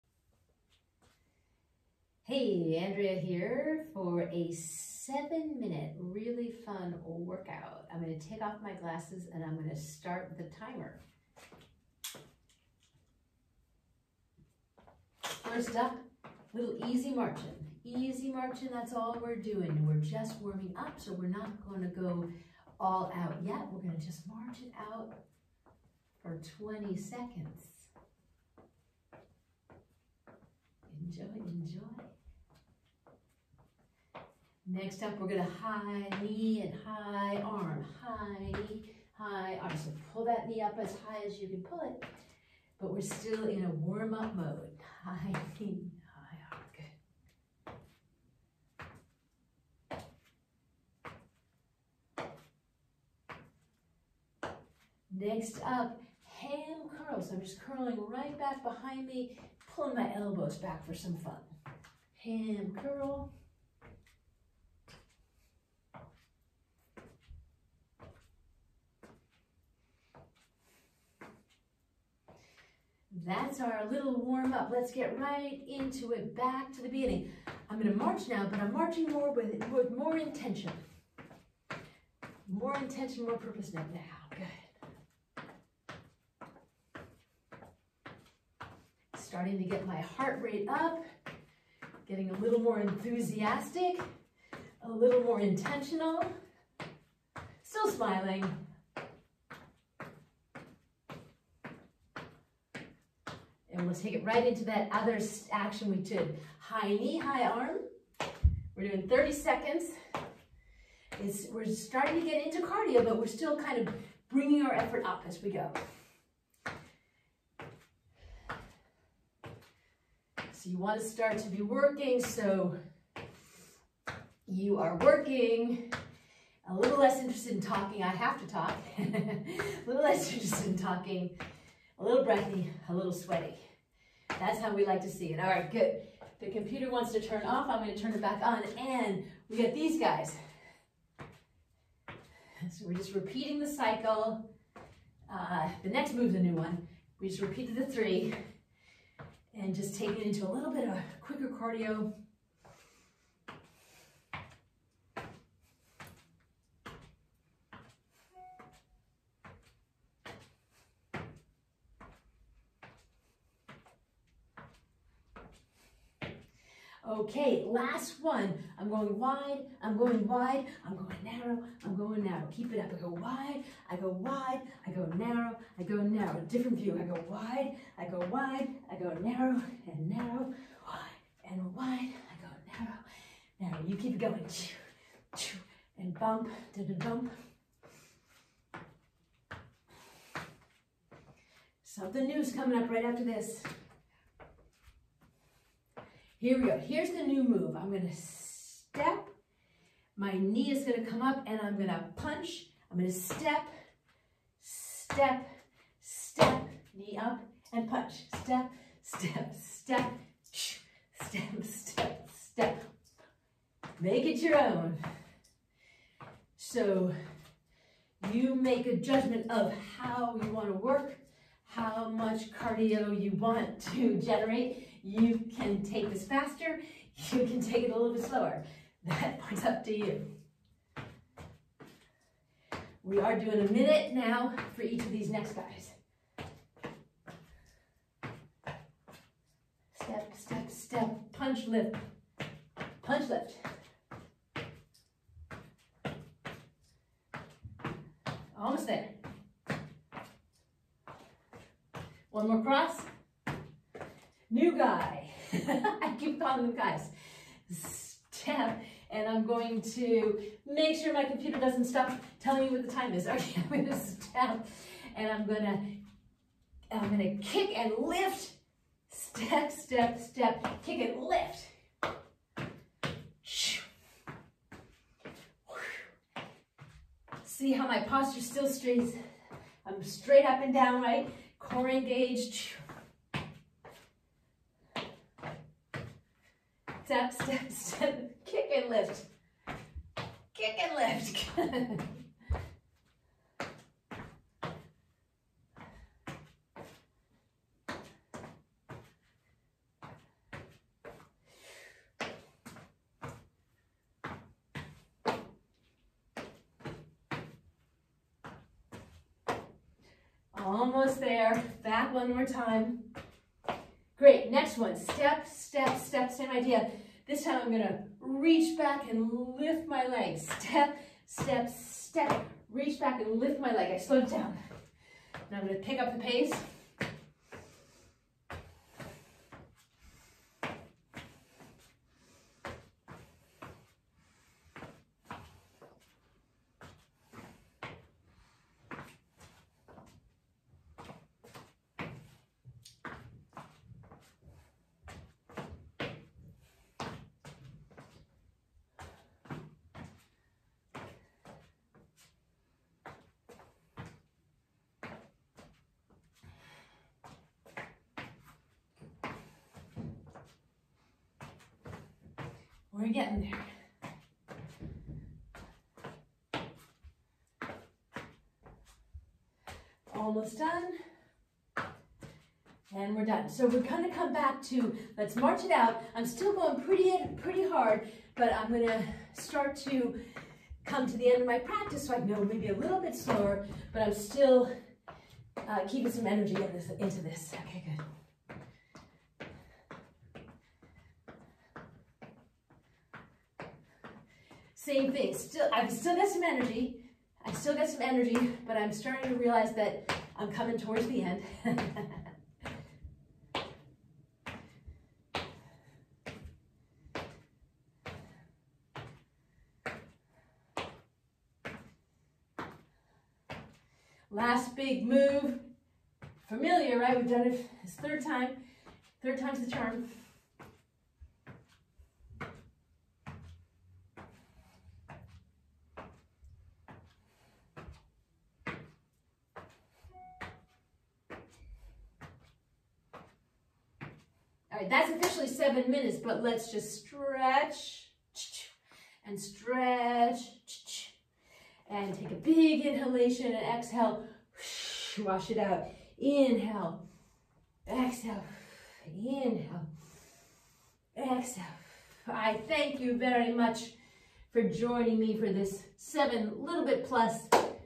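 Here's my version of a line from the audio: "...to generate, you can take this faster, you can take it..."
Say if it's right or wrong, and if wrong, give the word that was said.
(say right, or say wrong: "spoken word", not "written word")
right.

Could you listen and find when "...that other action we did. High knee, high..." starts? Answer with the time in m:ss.
1:44.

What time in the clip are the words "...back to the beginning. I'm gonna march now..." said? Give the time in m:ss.
1:16.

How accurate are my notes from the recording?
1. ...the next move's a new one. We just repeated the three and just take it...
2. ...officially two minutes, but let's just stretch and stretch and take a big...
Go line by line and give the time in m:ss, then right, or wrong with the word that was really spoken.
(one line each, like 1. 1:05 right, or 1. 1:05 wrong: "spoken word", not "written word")
1. 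2:25 right
2. 7:15 wrong: "seven", not "two".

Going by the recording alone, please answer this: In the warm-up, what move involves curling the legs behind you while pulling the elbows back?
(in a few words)
Ham curls.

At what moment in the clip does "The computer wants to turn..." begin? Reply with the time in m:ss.
2:16.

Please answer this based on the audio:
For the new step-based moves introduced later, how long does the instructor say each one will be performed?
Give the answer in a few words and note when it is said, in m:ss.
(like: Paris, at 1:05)
A minute, at 3:53.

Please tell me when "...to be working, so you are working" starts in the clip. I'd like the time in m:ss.
2:01.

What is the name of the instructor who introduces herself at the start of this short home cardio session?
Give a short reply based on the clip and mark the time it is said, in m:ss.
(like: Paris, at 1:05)
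Andrea, at 0:02.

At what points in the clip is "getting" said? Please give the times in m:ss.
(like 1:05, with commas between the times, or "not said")
1:32, 6:03.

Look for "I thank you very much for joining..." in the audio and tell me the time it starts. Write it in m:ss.
7:32.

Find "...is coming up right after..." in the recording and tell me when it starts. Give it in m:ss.
3:12.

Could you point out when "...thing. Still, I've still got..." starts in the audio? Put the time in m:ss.
6:35.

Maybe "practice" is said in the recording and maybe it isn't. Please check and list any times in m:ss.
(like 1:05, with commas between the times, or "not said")
6:21.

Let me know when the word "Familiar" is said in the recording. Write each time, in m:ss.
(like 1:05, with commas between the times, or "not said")
6:56.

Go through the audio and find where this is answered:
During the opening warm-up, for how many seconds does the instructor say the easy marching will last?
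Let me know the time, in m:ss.
0:26.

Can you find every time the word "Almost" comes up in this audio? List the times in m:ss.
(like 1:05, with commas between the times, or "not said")
4:08, 5:10, 6:10.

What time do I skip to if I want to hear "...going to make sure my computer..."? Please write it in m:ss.
4:19.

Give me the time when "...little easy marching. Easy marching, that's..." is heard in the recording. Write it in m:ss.
0:16.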